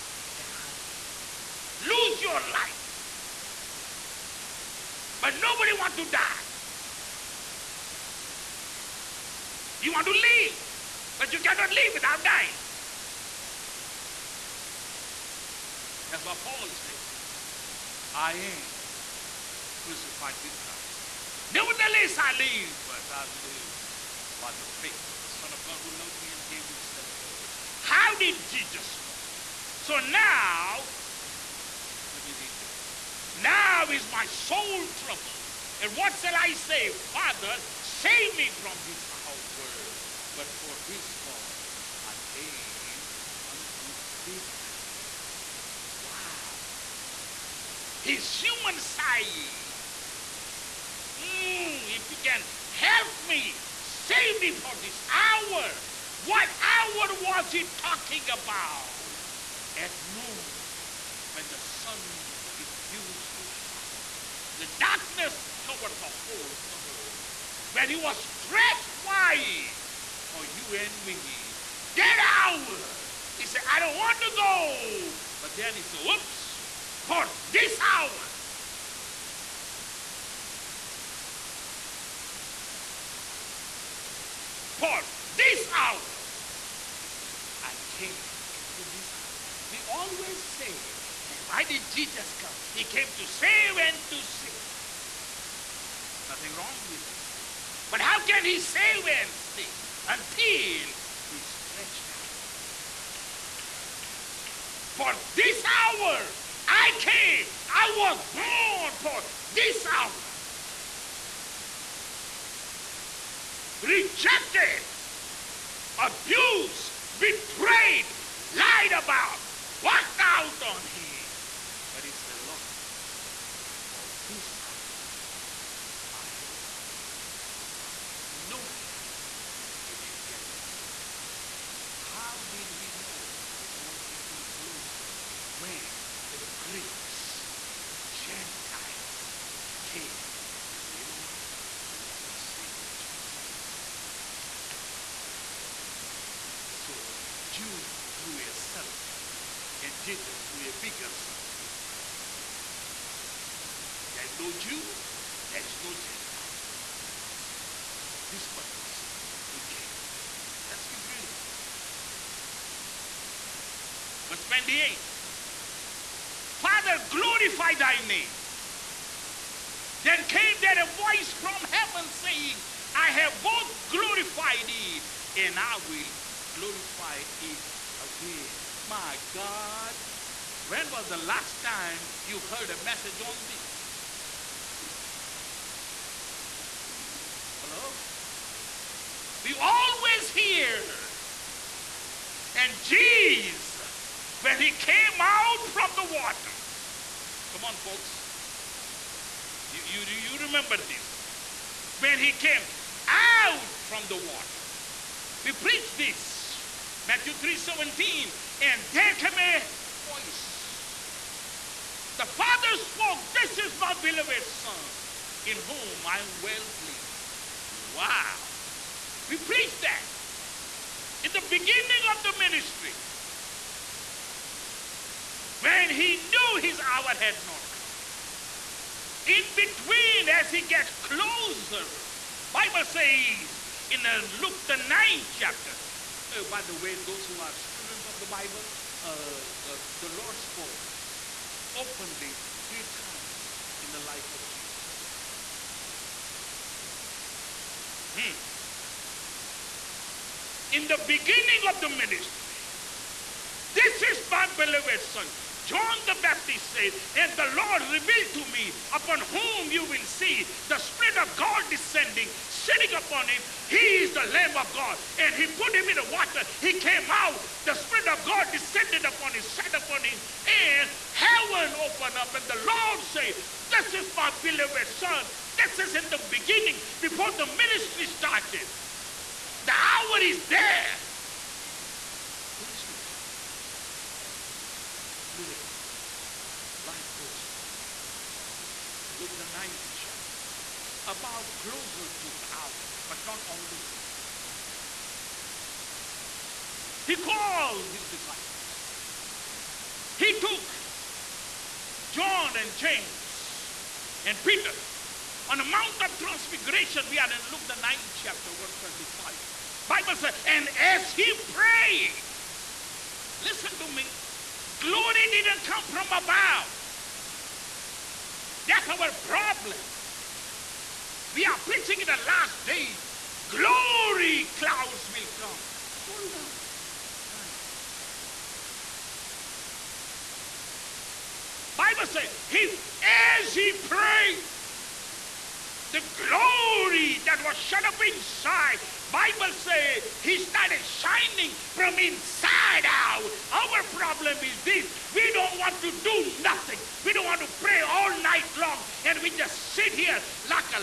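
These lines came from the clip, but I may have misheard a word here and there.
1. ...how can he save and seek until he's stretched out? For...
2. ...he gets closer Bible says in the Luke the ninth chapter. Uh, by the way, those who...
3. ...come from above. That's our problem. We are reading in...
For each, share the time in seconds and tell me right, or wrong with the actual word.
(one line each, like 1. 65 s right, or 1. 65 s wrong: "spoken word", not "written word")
1. 98 s right
2. 230 s right
3. 315 s wrong: "preaching", not "reading".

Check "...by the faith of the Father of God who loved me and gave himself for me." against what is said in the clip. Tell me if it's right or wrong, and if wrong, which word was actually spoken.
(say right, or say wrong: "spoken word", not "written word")
wrong: "Son", not "Father".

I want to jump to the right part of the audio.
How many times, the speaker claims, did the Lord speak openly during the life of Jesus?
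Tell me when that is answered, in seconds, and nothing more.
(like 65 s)
242 s.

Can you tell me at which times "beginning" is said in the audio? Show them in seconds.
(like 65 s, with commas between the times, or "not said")
221 s, 251 s, 276 s.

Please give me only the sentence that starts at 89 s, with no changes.
We always say, hey, why did Jesus come?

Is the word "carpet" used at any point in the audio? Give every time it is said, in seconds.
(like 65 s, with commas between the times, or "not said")
not said.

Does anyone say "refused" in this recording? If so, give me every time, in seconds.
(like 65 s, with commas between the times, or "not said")
62 s.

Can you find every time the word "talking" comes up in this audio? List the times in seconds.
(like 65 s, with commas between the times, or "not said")
57 s.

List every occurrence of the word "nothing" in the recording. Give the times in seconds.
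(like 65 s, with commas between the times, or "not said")
96 s, 346 s.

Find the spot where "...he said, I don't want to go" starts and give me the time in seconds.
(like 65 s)
73 s.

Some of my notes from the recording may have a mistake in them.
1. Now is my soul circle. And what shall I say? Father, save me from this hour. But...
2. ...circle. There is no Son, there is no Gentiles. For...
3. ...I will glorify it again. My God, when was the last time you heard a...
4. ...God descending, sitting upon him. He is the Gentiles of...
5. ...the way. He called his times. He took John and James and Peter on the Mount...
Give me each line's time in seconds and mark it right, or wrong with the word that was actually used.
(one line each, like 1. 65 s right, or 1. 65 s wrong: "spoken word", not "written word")
1. 33 s wrong: "trouble", not "circle"
2. 151 s wrong: "Jews", not "Son"
3. 175 s right
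4. 261 s wrong: "Lamb", not "Gentiles"
5. 293 s wrong: "disciples", not "times".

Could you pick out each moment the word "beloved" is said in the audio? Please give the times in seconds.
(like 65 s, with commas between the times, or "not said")
214 s, 254 s, 274 s.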